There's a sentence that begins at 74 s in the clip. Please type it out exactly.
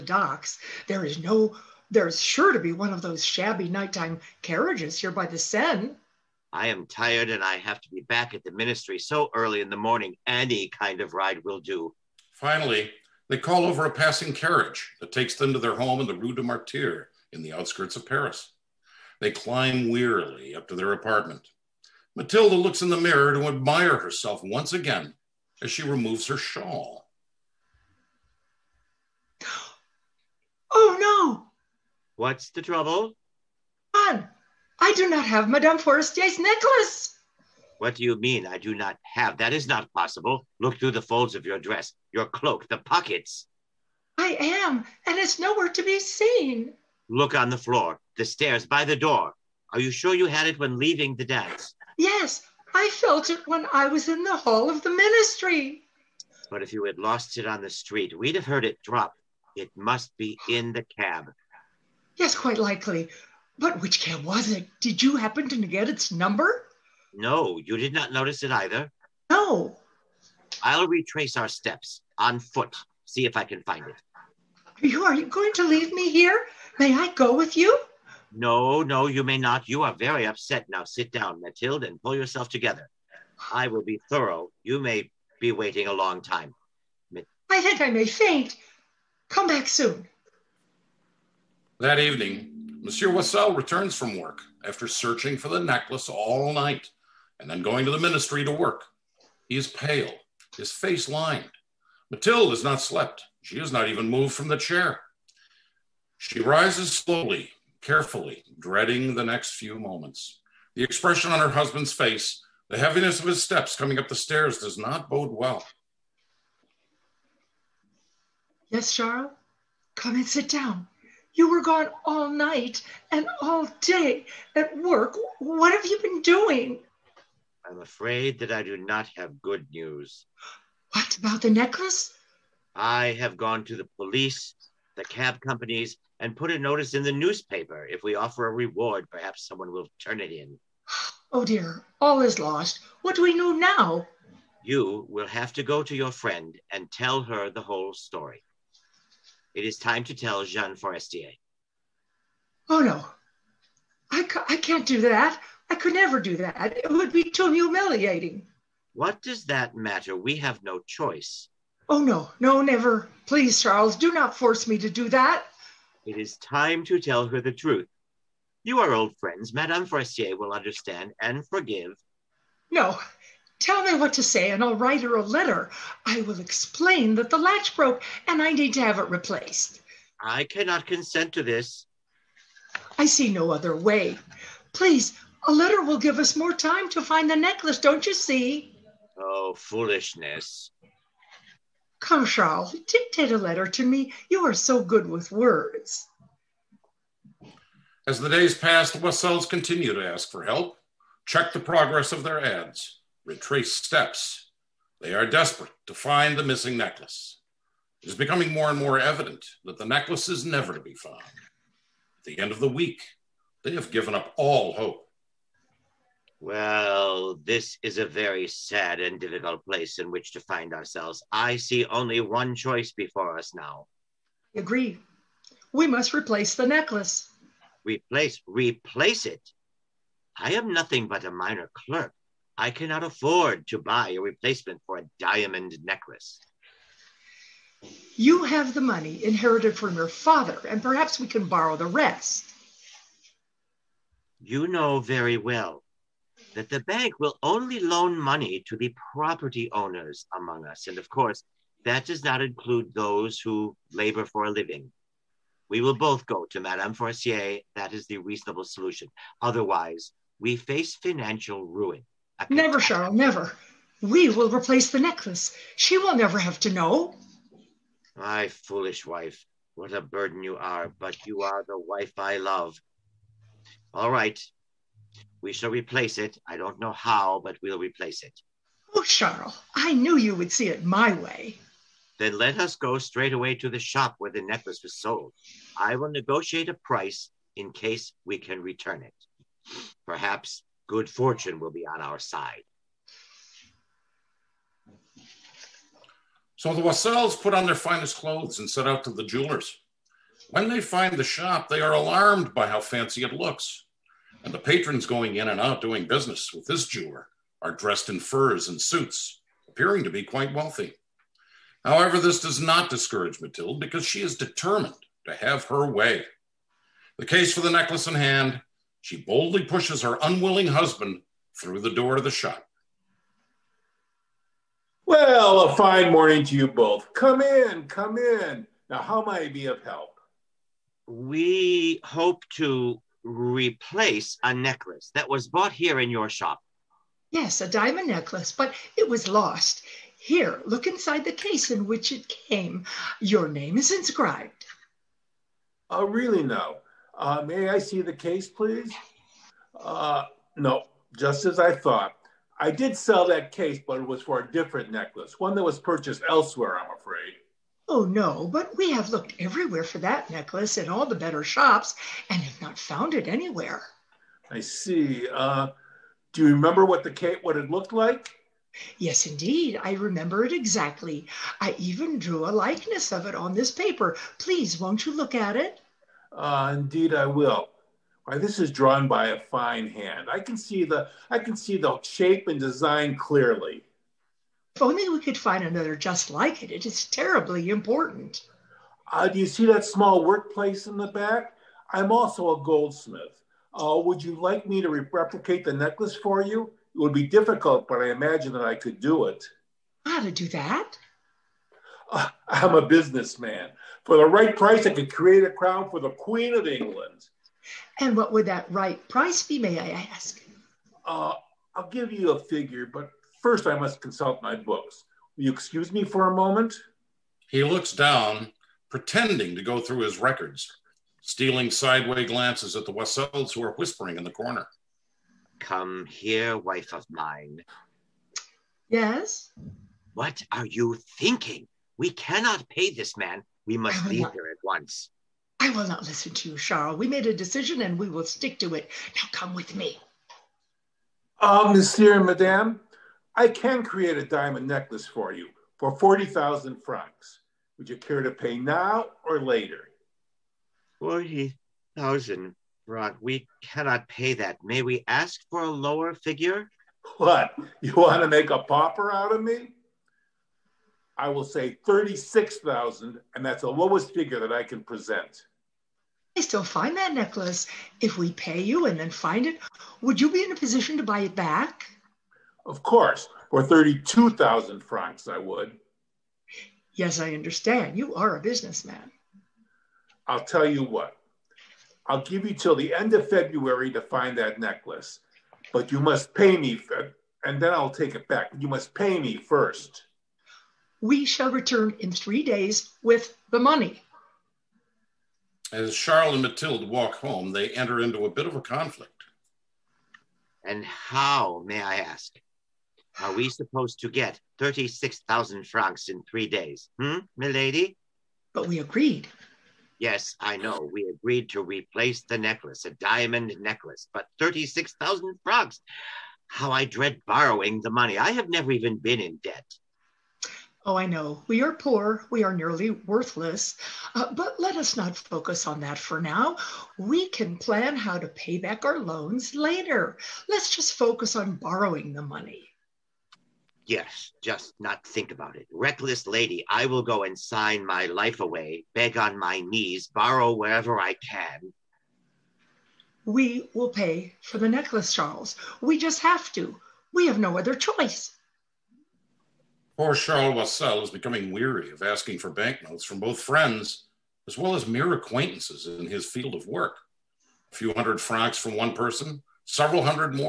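you, are you going to leave me here?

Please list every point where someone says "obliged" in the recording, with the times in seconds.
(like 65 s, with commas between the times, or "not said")
not said.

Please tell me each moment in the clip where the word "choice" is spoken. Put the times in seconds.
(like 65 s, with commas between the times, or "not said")
160 s, 222 s, 547 s.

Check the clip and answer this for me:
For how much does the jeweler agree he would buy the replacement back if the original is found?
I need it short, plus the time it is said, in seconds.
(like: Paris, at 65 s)
32,000 francs, at 473 s.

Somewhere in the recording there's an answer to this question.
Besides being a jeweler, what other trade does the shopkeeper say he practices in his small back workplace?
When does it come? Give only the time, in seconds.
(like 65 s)
392 s.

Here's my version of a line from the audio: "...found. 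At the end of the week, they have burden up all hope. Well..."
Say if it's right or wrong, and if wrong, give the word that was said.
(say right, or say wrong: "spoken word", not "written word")
wrong: "given", not "burden".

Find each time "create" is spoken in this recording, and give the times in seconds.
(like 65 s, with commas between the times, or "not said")
405 s, 443 s.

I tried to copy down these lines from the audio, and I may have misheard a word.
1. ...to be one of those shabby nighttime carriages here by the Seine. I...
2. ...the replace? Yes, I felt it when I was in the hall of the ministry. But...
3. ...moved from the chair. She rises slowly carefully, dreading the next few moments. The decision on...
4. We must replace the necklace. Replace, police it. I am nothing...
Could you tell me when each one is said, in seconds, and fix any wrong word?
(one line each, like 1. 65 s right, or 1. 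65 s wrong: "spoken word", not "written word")
1. 2 s right
2. 51 s wrong: "dance", not "replace"
3. 104 s wrong: "expression", not "decision"
4. 225 s wrong: "replace", not "police".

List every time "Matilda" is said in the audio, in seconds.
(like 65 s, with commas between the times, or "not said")
22 s, 313 s.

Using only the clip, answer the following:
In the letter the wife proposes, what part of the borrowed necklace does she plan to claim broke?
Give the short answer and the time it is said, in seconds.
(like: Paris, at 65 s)
the latch, at 177 s.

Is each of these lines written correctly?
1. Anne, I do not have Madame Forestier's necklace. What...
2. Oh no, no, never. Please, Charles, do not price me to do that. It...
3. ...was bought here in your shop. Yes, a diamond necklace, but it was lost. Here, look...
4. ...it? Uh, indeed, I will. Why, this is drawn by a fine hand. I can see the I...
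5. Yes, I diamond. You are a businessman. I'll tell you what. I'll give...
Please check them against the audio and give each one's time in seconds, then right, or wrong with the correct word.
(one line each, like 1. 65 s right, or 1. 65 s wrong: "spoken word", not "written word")
1. 33 s right
2. 161 s wrong: "force", not "price"
3. 335 s right
4. 375 s right
5. 476 s wrong: "understand", not "diamond".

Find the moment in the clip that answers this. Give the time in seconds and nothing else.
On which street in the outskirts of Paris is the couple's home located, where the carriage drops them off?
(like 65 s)
16 s.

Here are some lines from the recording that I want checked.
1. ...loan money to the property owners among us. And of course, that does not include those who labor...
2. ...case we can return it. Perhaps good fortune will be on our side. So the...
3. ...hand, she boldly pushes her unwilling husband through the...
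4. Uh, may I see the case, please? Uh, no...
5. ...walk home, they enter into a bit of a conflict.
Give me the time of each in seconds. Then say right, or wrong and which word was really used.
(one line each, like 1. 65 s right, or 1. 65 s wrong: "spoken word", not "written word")
1. 247 s right
2. 287 s right
3. 318 s right
4. 347 s right
5. 496 s right.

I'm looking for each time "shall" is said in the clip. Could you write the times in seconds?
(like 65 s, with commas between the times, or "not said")
275 s, 491 s.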